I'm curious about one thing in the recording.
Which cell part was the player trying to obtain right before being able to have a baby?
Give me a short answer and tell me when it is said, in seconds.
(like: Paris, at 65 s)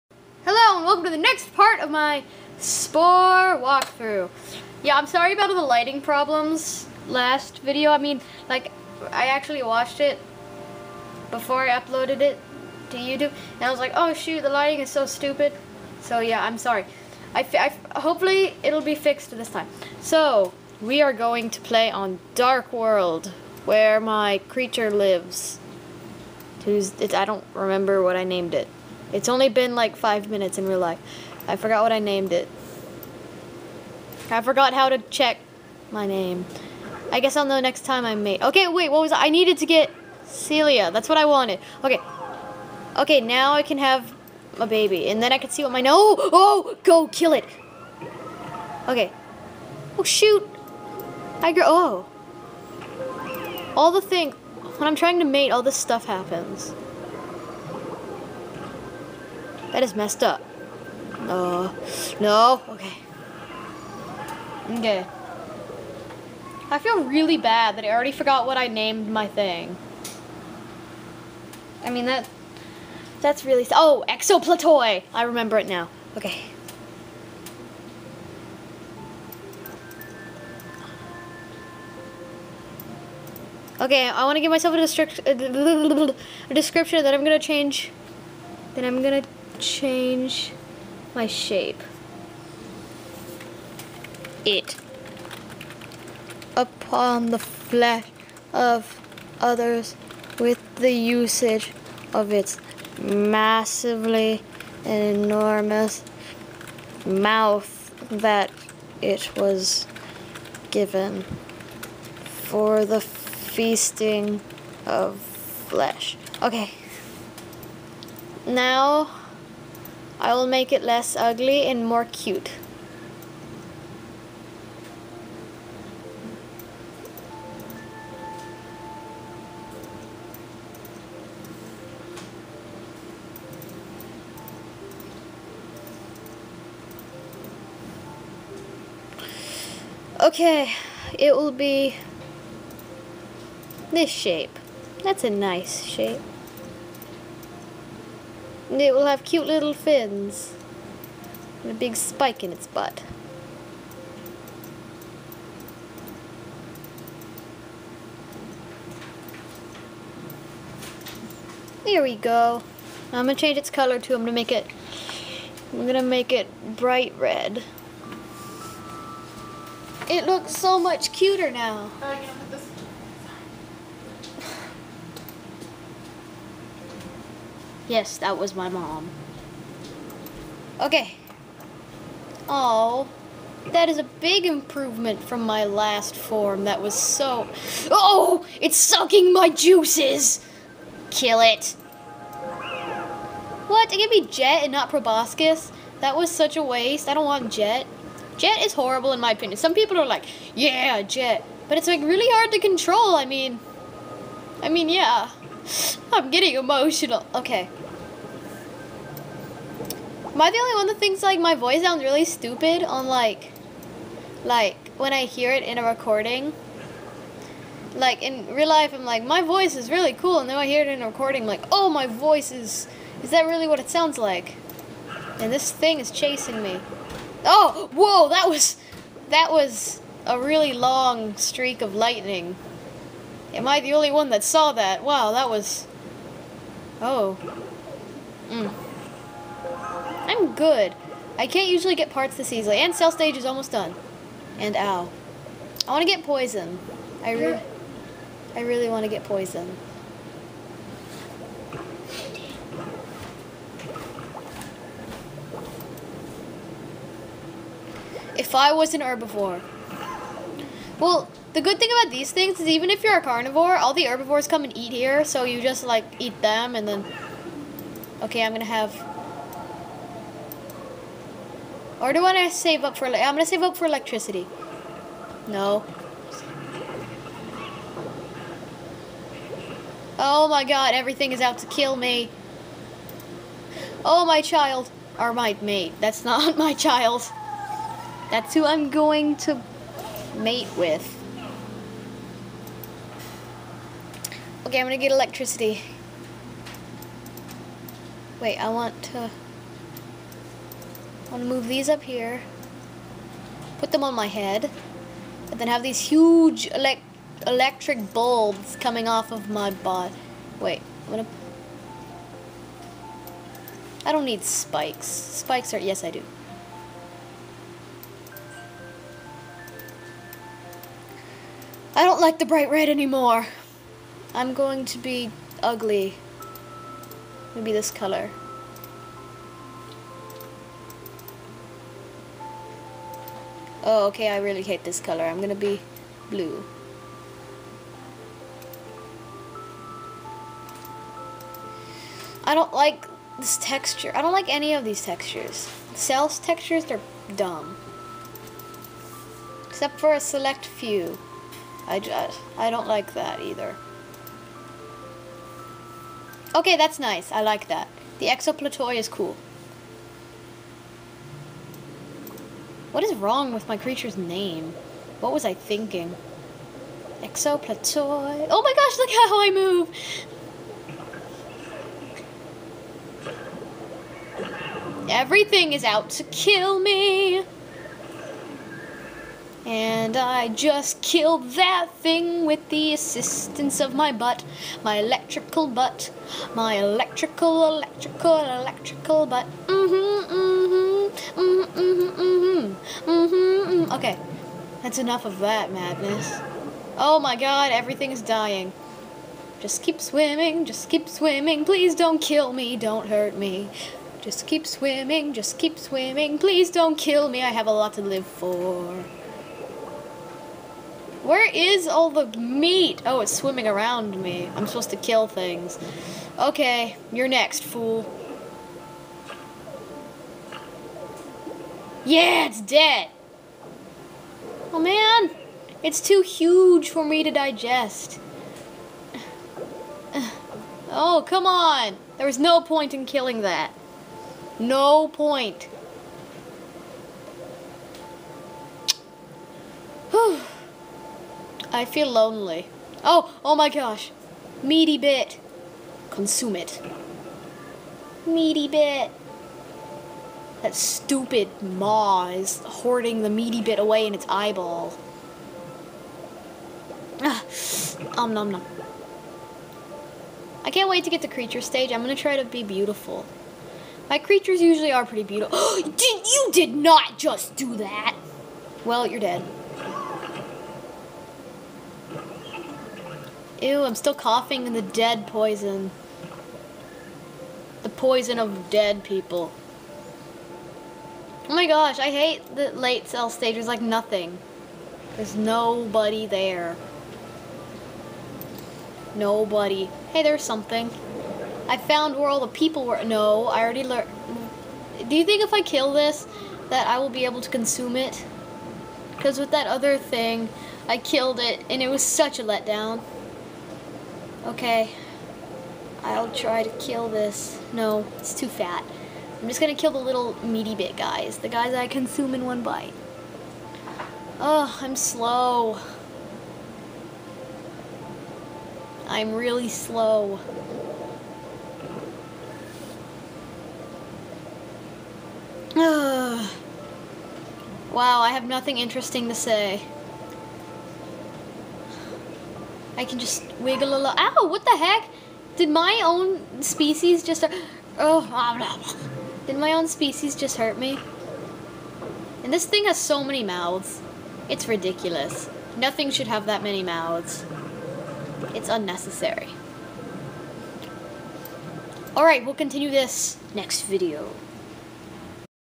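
cilia, at 40 s.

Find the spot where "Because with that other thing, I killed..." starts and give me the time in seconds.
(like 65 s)
499 s.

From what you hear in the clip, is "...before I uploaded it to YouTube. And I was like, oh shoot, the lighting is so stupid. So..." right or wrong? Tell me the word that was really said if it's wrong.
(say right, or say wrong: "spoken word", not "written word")
right.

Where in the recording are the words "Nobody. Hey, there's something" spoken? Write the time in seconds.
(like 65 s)
489 s.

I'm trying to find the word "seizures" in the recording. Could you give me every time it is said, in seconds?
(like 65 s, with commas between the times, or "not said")
not said.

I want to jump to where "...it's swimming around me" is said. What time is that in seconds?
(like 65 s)
413 s.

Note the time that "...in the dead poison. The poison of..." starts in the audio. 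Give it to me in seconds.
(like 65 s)
474 s.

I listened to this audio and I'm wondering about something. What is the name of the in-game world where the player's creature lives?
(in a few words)
Dark World.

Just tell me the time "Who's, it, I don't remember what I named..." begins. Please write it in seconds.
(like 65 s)
26 s.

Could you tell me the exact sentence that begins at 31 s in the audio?
I forgot what I named it.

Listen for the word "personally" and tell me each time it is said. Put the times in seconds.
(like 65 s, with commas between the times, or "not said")
not said.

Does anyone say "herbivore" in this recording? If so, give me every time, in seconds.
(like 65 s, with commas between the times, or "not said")
259 s, 264 s.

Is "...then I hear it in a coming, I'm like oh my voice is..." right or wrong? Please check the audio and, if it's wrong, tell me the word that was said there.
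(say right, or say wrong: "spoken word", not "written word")
wrong: "recording", not "coming".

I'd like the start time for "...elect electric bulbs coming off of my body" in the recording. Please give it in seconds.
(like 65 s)
306 s.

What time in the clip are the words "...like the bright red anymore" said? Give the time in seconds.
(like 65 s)
322 s.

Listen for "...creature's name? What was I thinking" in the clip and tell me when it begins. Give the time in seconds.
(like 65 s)
363 s.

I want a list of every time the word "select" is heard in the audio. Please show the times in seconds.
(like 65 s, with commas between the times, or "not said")
350 s.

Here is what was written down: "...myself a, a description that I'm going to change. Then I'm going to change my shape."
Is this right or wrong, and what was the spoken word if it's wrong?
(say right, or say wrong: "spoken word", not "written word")
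right.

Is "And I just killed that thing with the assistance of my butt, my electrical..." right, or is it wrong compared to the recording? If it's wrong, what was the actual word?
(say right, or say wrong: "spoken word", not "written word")
right.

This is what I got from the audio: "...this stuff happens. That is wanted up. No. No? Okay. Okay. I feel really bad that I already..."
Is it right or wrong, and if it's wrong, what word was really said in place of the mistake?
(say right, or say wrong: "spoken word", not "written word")
wrong: "messed", not "wanted".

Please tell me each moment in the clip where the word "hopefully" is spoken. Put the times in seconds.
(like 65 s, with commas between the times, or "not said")
17 s.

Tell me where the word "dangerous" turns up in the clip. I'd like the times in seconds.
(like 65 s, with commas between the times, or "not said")
not said.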